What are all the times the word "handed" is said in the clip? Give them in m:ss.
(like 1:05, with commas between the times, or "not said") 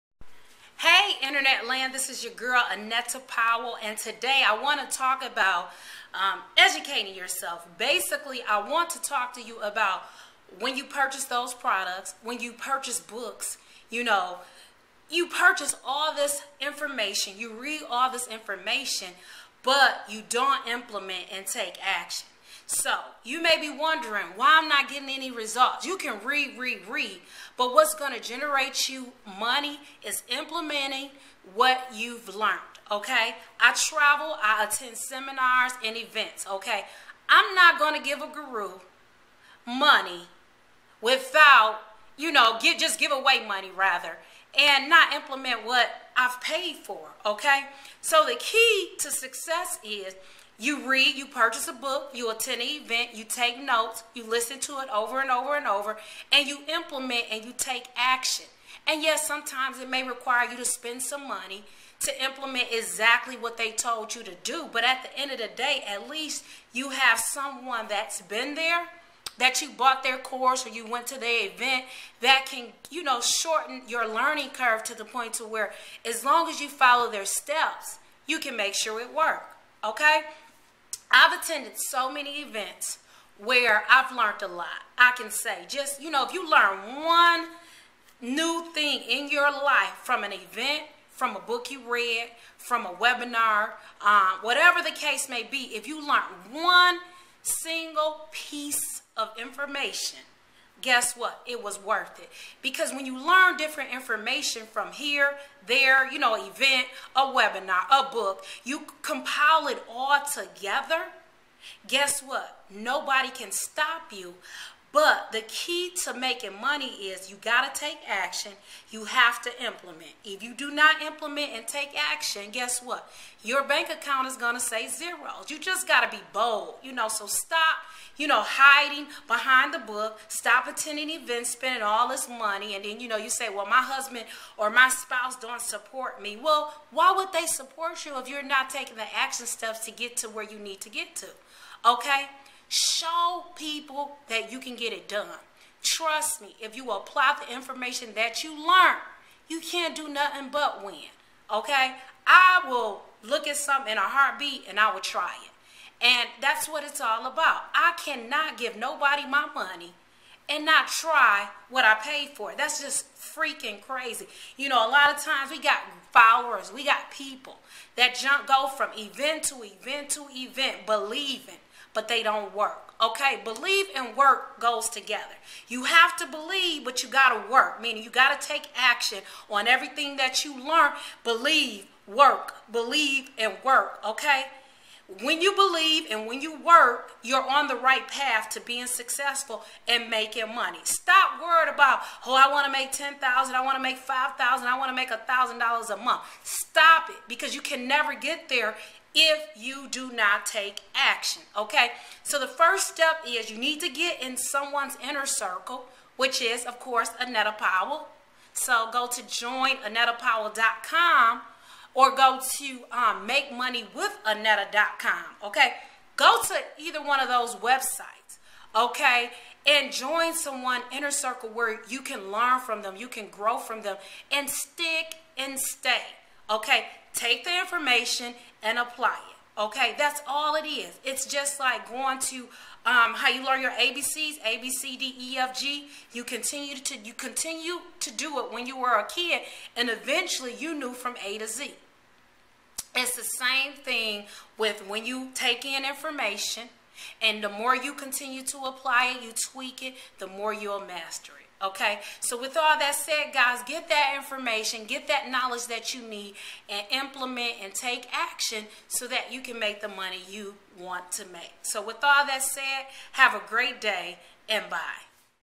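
not said.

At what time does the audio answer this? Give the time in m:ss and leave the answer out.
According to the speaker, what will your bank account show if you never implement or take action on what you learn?
2:04.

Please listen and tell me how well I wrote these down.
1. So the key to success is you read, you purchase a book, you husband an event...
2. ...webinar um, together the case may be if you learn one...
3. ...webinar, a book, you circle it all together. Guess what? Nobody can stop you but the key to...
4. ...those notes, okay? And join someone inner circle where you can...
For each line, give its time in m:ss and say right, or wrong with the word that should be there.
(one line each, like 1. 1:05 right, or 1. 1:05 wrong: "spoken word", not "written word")
1. 0:48 wrong: "attend", not "husband"
2. 1:32 wrong: "whatever", not "together"
3. 1:47 wrong: "compile", not "circle"
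4. 3:37 wrong: "websites", not "notes".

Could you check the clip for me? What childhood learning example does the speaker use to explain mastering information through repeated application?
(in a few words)
ABCs.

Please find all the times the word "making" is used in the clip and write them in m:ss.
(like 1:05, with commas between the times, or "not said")
1:56, 3:10.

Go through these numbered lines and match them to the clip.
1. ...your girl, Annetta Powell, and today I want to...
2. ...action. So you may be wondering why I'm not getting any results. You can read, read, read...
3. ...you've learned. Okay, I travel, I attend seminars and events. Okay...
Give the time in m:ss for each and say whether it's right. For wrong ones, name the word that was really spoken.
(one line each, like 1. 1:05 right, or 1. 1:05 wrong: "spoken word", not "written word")
1. 0:02 right
2. 0:21 right
3. 0:31 right.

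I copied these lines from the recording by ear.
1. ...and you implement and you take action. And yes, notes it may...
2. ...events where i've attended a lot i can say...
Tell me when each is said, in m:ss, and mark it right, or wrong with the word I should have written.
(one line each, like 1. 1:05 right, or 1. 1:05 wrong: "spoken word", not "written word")
1. 0:56 wrong: "sometimes", not "notes"
2. 1:22 wrong: "learned", not "attended".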